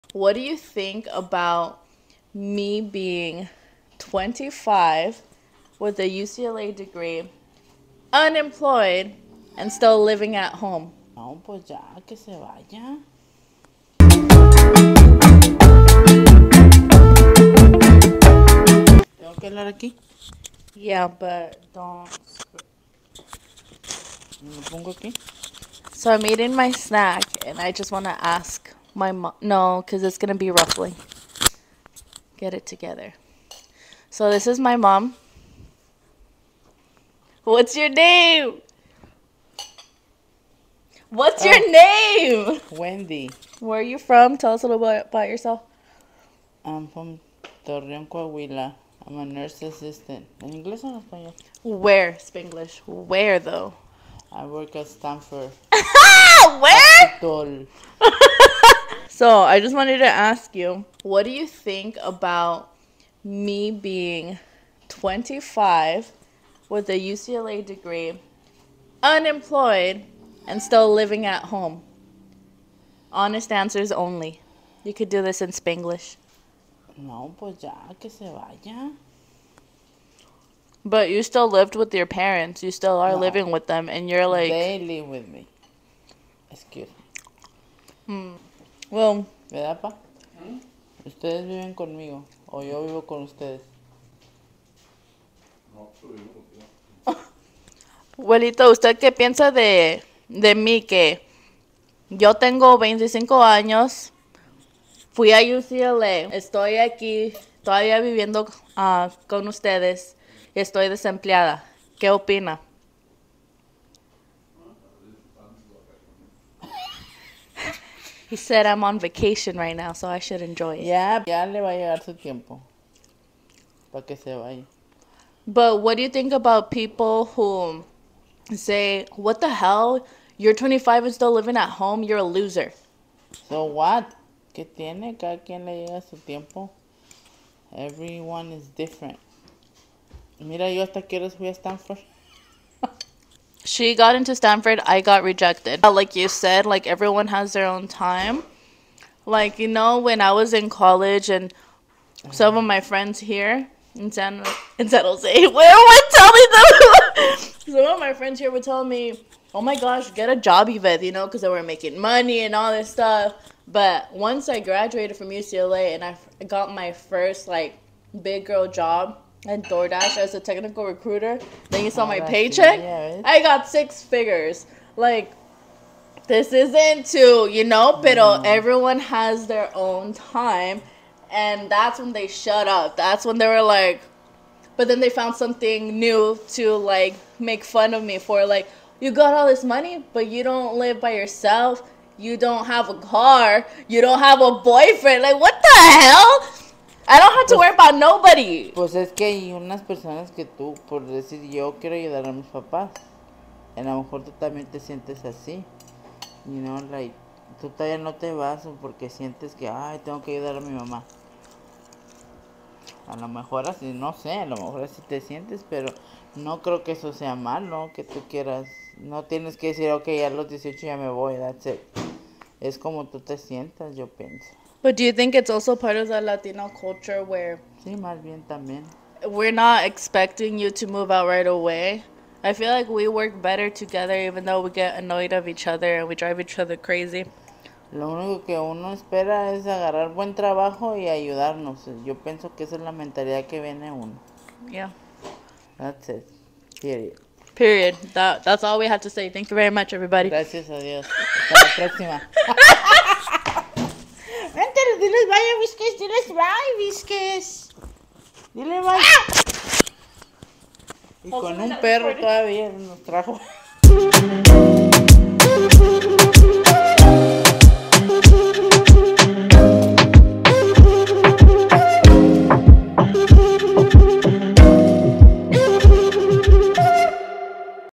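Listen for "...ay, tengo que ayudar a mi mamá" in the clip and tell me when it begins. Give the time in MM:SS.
03:29.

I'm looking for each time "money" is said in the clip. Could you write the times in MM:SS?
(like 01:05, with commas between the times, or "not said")
02:41, 03:09.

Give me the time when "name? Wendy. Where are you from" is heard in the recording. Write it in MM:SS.
00:42.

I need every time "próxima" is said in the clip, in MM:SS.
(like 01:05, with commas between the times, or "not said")
04:11.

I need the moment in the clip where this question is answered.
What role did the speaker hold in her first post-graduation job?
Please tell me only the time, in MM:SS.
02:50.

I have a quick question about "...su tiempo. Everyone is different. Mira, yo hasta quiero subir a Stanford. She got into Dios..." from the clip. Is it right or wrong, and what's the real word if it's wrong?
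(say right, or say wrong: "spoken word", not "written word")
wrong: "Stanford", not "Dios".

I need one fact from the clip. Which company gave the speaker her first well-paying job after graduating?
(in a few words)
DoorDash.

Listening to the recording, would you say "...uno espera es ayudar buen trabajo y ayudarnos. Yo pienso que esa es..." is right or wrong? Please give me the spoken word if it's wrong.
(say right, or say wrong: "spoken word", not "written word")
wrong: "agarrar", not "ayudar".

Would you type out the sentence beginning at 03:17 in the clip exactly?
I don't have to pues, worry Pues es que hay unas personas que tú, por decir, yo quiero ayudar a mis papás.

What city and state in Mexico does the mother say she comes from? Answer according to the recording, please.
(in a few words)
Torreon, Coahuila.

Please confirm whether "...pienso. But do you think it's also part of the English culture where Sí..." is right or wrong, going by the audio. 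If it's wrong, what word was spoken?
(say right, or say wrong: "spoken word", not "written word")
wrong: "Latino", not "English".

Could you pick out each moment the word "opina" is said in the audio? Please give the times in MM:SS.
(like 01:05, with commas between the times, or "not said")
01:52.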